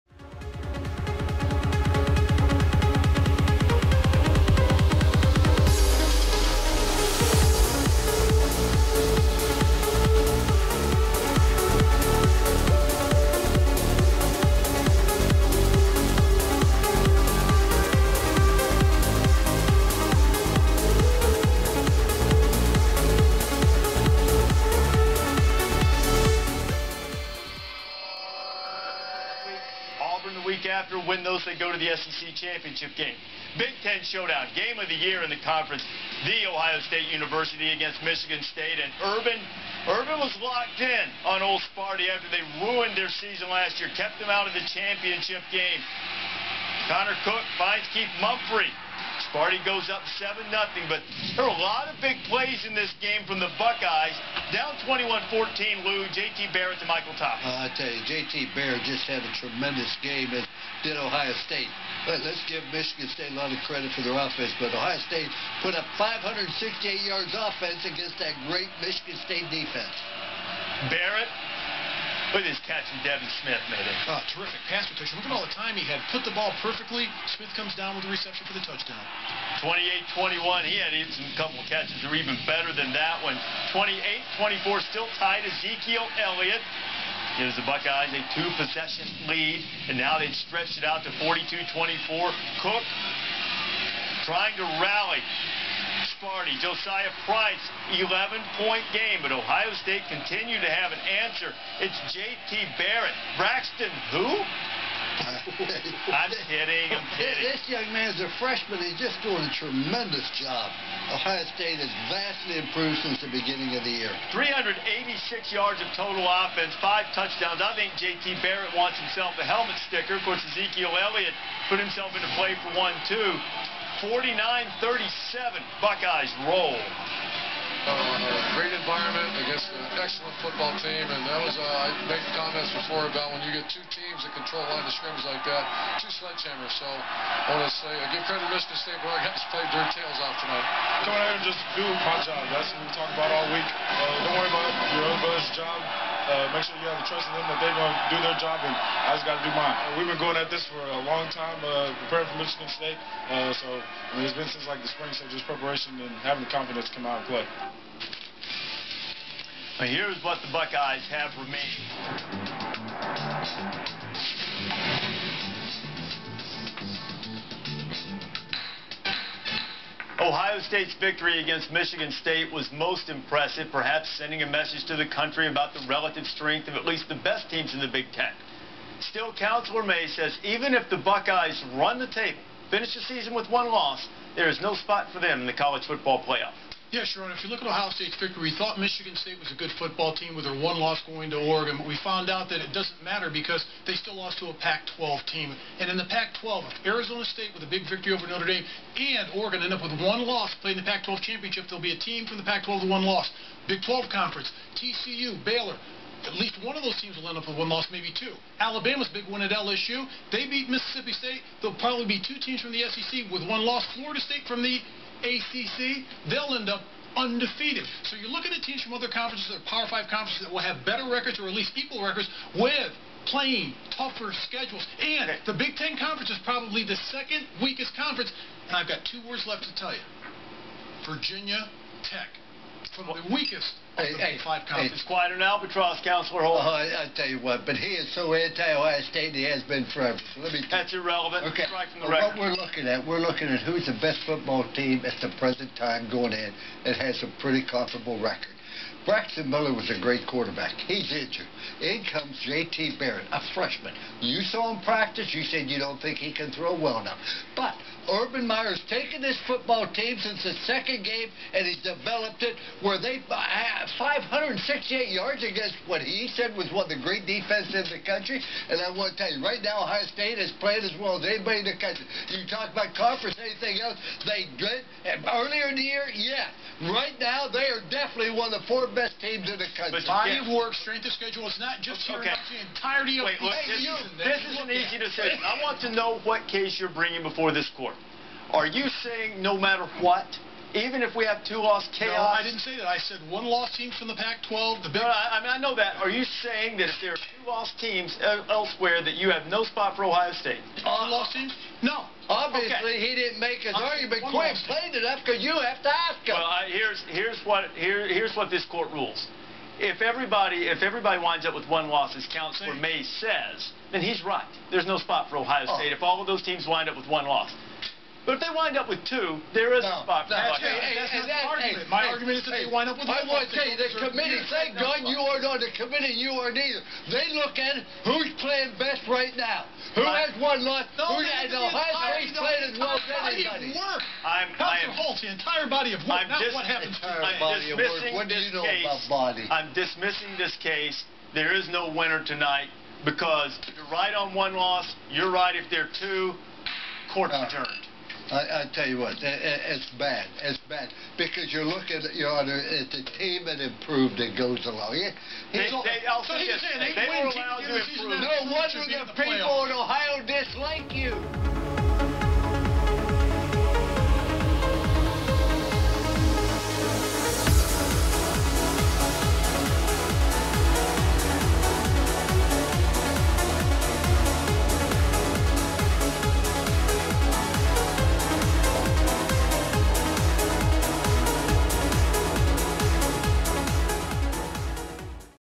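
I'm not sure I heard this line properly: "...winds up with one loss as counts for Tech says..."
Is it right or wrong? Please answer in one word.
wrong.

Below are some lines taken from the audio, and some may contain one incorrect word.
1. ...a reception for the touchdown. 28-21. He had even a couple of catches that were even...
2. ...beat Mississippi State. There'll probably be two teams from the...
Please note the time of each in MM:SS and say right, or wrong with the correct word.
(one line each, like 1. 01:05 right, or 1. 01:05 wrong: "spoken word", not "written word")
1. 01:18 right
2. 03:30 right.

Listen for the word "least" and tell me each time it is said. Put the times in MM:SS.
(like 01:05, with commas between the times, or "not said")
02:56, 03:26, 03:41.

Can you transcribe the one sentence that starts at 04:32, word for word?
You talk about conference, anything else, they did.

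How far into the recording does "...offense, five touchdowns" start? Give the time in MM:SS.
01:56.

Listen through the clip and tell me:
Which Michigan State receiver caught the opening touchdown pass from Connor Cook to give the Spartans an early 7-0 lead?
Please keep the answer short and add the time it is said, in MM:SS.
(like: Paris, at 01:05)
Keith Mumphrey, at 00:47.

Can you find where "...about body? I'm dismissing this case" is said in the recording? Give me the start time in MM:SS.
05:38.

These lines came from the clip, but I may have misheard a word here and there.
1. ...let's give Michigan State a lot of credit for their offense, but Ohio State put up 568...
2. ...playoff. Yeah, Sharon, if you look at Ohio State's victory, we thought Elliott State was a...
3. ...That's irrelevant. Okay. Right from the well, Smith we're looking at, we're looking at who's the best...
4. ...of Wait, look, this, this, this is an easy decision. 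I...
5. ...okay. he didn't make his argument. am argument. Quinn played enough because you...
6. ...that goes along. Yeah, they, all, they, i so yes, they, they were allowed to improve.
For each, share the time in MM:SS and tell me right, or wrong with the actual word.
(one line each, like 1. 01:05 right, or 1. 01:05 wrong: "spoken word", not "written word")
1. 01:02 right
2. 03:06 wrong: "Michigan", not "Elliott"
3. 04:00 wrong: "What", not "Smith"
4. 04:43 right
5. 05:02 right
6. 05:54 right.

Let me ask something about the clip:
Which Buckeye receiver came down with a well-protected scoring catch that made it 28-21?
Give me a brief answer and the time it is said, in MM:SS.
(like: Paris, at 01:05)
Devin Smith, at 01:13.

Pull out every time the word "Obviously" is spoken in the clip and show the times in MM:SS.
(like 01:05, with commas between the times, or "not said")
05:02.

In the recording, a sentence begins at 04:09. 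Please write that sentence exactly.
Braxton Miller was a great quarterback.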